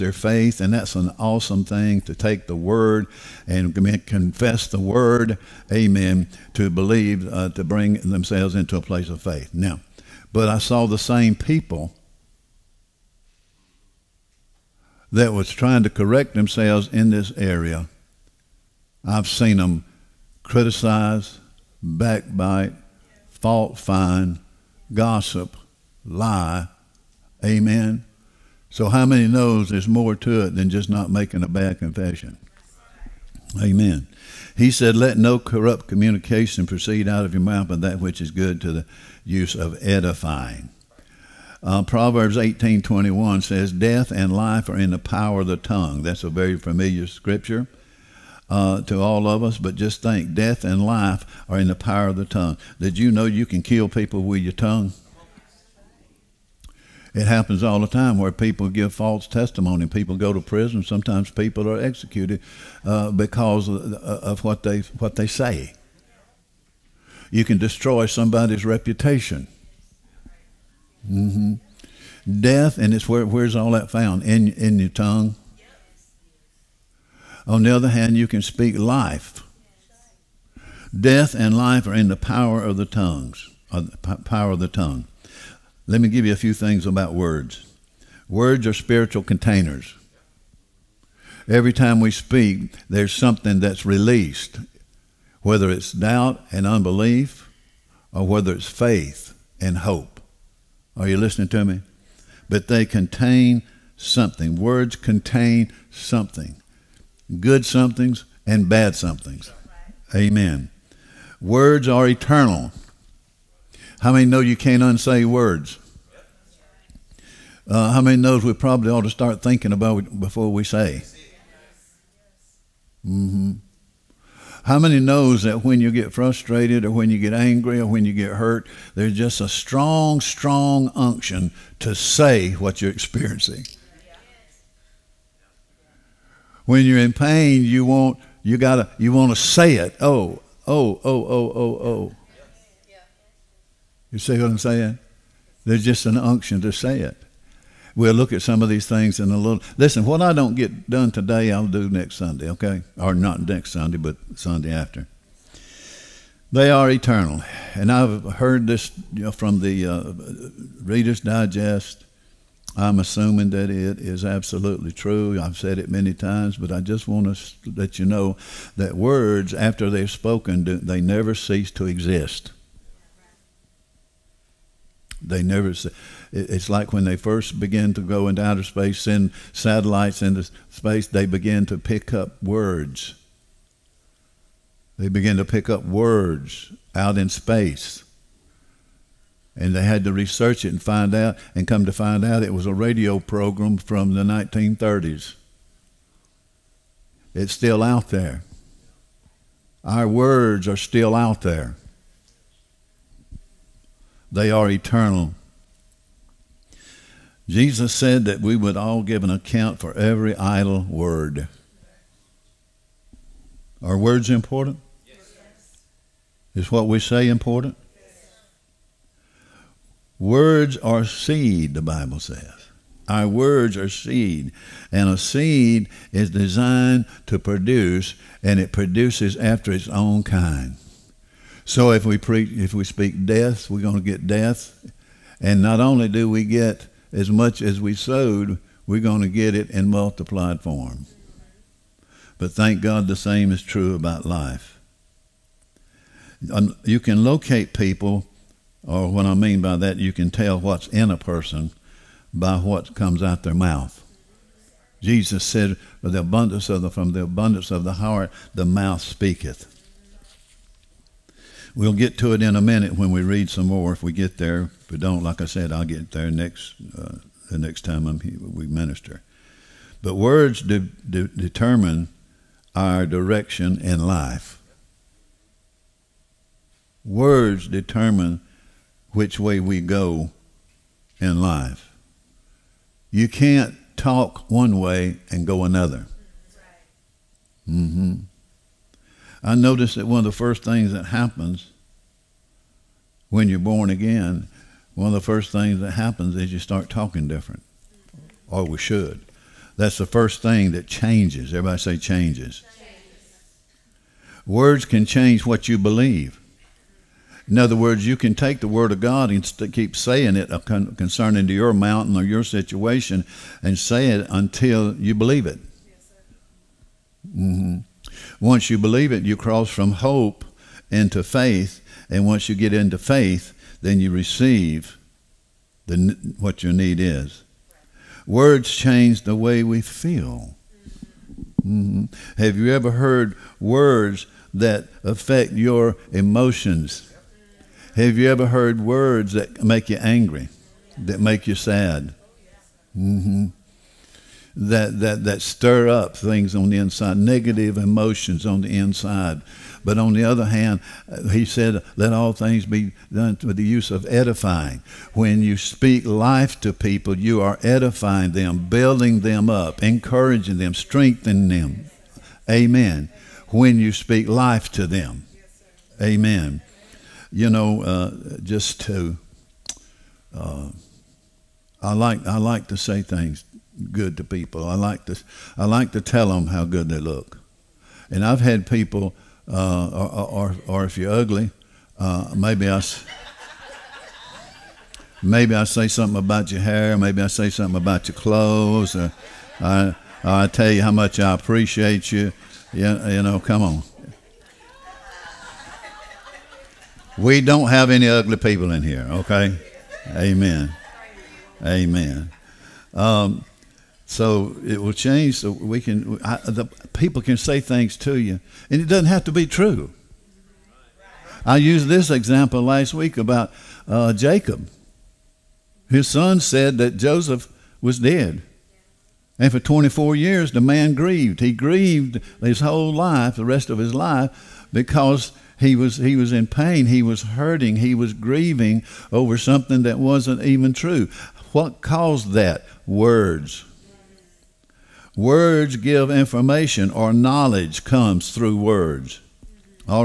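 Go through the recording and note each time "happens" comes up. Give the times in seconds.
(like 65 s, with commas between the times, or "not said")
57 s, 291 s, 295 s.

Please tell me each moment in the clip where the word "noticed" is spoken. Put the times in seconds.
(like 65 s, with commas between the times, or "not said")
289 s.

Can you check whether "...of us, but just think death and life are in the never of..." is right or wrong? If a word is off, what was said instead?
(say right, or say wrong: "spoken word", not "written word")
wrong: "power", not "never".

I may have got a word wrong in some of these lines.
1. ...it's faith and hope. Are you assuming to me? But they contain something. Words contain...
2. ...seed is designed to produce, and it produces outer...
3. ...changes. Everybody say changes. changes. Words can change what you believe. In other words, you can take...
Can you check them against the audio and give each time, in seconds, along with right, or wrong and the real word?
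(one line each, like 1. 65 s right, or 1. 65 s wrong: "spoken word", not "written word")
1. 98 s wrong: "listening", not "assuming"
2. 225 s wrong: "after", not "outer"
3. 300 s right.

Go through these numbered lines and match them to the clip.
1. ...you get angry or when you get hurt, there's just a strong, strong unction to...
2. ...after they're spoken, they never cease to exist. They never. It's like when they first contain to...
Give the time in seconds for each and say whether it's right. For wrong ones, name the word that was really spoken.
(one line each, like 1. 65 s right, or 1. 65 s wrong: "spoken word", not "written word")
1. 127 s right
2. 169 s wrong: "begin", not "contain".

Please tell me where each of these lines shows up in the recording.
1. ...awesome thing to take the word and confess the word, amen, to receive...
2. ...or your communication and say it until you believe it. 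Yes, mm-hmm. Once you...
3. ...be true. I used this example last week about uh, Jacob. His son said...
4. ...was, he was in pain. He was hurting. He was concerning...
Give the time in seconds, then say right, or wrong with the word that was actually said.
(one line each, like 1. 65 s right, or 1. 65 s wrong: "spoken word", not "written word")
1. 1 s wrong: "believe", not "receive"
2. 312 s wrong: "situation", not "communication"
3. 409 s right
4. 425 s wrong: "grieving", not "concerning".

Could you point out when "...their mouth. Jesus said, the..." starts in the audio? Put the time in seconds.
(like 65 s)
253 s.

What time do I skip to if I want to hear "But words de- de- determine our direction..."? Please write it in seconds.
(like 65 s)
270 s.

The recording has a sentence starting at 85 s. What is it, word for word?
Let me give you a few things about words.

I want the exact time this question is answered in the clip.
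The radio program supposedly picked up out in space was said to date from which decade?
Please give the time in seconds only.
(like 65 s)
194 s.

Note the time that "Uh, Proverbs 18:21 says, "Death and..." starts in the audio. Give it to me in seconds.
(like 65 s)
41 s.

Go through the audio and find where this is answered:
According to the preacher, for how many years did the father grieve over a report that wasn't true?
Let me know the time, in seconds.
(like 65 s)
419 s.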